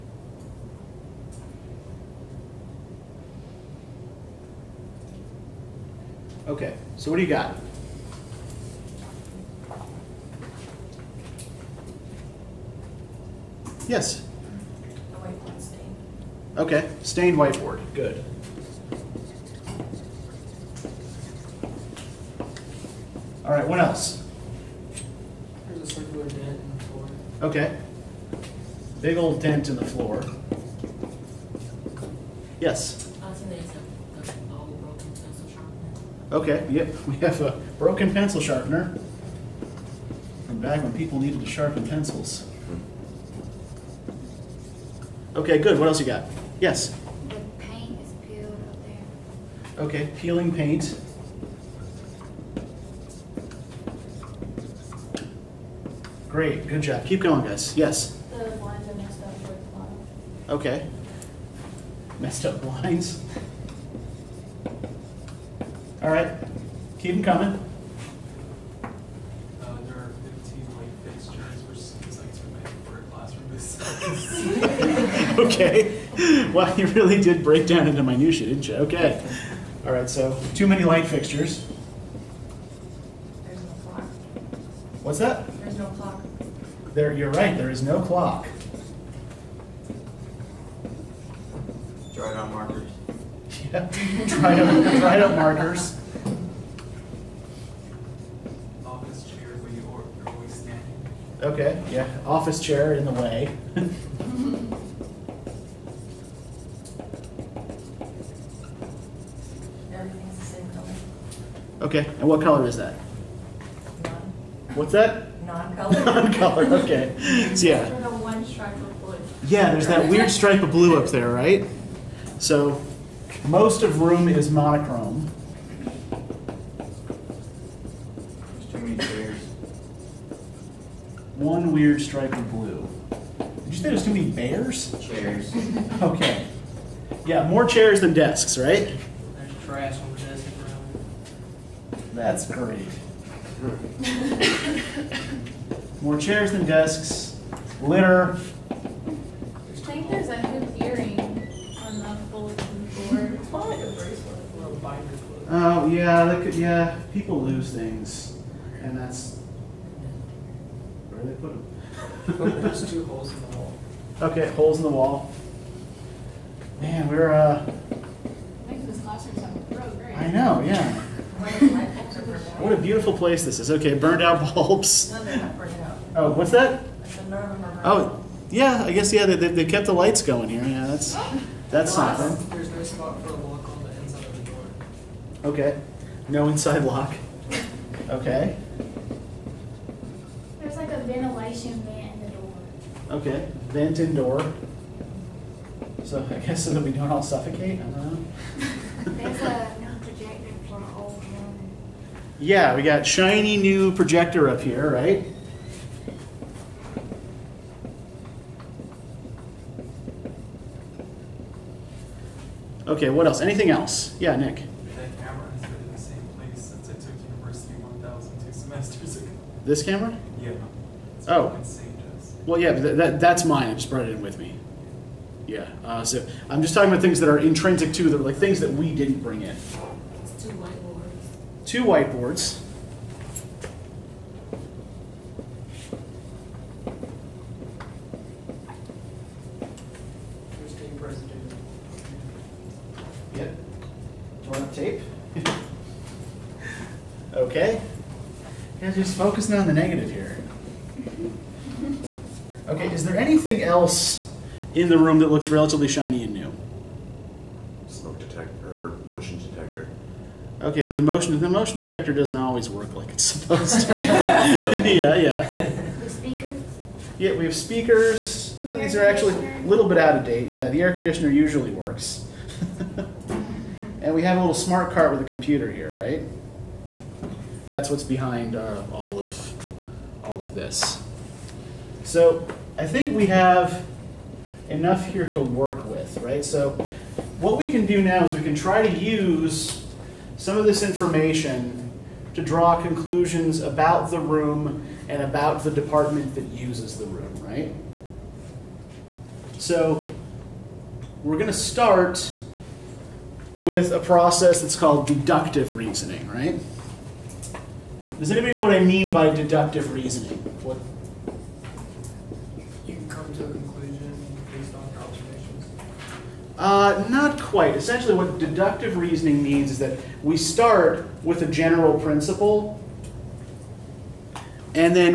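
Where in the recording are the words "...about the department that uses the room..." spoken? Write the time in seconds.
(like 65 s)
295 s.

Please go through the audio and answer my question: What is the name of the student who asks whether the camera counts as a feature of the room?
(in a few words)
Nick.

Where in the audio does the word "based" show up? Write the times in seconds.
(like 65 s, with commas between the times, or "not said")
314 s.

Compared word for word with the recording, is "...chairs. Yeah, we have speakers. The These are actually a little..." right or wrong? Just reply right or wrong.
wrong.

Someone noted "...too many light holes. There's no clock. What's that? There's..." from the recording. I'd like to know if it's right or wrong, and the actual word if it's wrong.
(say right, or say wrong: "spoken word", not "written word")
wrong: "fixtures", not "holes".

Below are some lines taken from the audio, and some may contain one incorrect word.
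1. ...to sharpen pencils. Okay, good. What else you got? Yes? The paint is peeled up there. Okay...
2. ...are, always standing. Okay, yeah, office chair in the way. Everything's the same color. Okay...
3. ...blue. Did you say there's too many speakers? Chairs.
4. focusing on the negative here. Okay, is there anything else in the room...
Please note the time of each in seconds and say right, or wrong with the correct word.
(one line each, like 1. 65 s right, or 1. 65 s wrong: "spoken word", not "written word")
1. 41 s right
2. 99 s right
3. 132 s wrong: "bears", not "speakers"
4. 249 s right.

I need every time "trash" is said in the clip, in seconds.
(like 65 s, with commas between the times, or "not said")
139 s.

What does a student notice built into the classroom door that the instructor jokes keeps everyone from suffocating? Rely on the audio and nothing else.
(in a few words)
ventilation vent.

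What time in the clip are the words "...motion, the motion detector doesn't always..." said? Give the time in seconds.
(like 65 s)
261 s.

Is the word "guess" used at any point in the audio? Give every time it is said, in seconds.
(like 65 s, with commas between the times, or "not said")
178 s, 196 s.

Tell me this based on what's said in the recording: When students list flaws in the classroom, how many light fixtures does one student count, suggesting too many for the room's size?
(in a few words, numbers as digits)
15.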